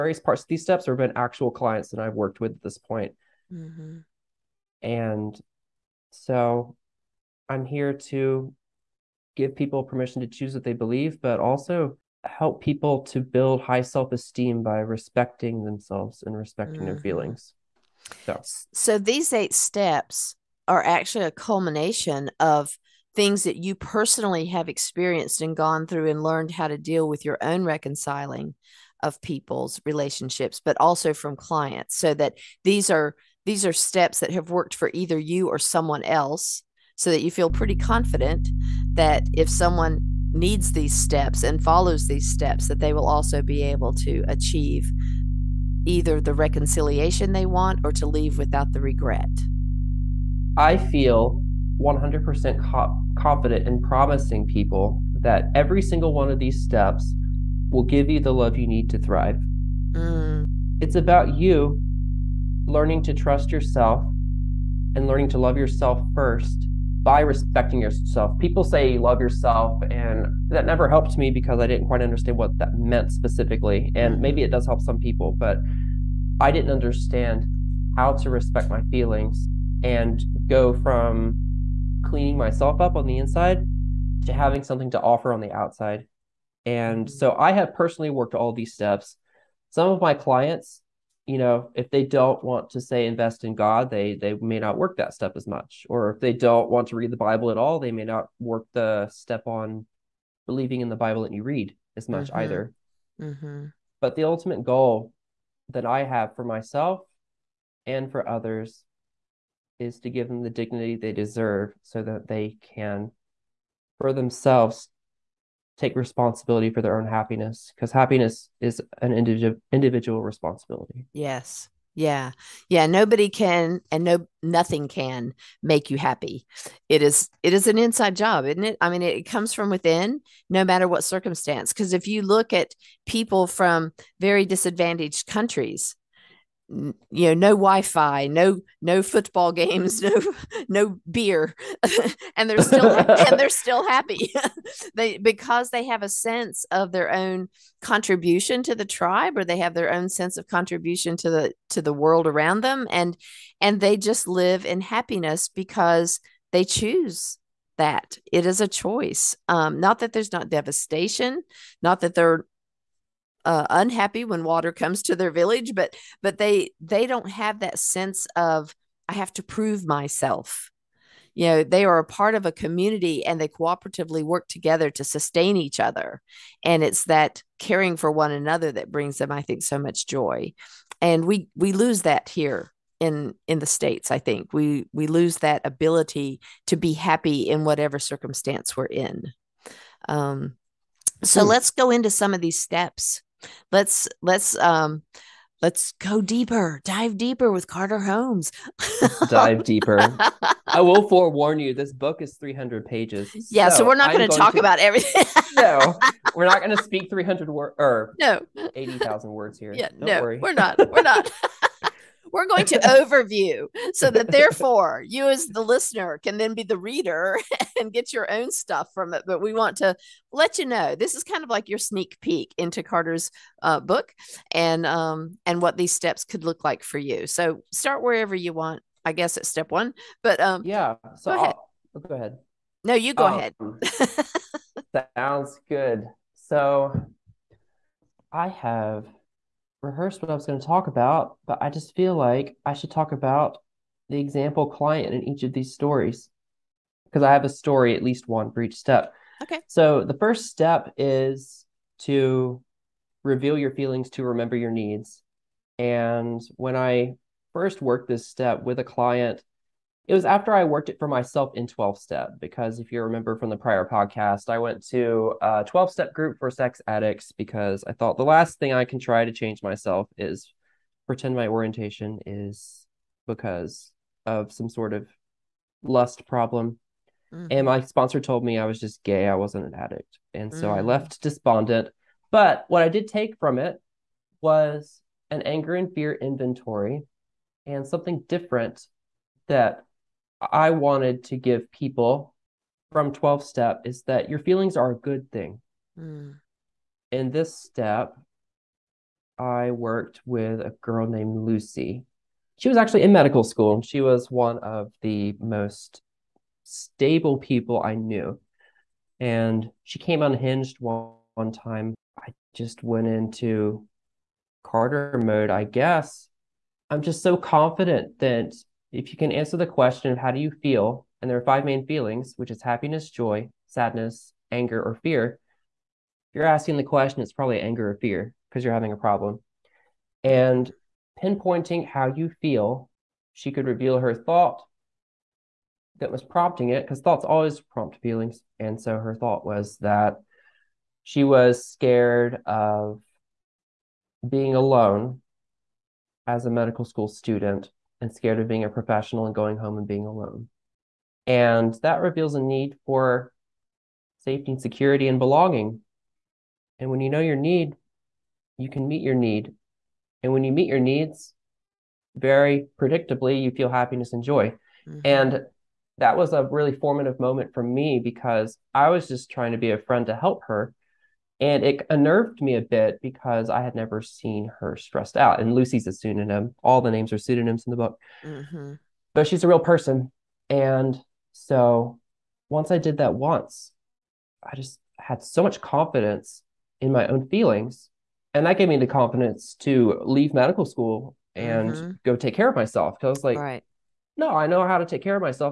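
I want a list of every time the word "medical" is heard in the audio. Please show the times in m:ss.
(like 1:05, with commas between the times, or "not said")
5:03, 5:46, 6:30.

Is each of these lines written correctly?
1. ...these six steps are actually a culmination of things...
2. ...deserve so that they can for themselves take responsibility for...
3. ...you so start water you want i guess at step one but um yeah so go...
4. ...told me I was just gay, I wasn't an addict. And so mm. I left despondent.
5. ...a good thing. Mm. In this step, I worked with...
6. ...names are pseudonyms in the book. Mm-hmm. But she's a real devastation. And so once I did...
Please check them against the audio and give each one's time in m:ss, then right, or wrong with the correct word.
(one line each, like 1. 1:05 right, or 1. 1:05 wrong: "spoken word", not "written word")
1. 0:18 wrong: "eight", not "six"
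2. 1:51 right
3. 3:46 wrong: "wherever", not "water"
4. 4:38 right
5. 4:54 right
6. 6:16 wrong: "person", not "devastation".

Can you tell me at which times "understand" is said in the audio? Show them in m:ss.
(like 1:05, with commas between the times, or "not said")
1:12, 1:16.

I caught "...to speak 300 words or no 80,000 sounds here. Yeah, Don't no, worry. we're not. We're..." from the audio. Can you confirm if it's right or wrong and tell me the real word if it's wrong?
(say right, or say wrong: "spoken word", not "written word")
wrong: "words", not "sounds".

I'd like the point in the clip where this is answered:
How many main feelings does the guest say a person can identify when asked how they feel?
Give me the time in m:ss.
5:21.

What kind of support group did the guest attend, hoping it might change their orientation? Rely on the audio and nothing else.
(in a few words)
12 step group for sex addicts.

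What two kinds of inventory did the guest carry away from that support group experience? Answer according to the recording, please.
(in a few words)
anger and fear inventory.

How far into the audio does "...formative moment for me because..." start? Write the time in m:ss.
6:06.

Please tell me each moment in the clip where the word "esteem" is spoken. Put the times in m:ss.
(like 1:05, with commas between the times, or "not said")
0:14.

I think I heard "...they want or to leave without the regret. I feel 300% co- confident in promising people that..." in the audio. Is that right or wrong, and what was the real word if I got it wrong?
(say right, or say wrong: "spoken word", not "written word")
wrong: "100", not "300".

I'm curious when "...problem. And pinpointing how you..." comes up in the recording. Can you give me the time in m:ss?
5:28.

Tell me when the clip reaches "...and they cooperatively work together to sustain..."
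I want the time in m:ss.
2:53.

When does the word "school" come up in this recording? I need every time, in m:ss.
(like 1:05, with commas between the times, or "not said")
5:03, 5:46, 6:30.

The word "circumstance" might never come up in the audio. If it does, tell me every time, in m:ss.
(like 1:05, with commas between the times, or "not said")
2:11, 3:07.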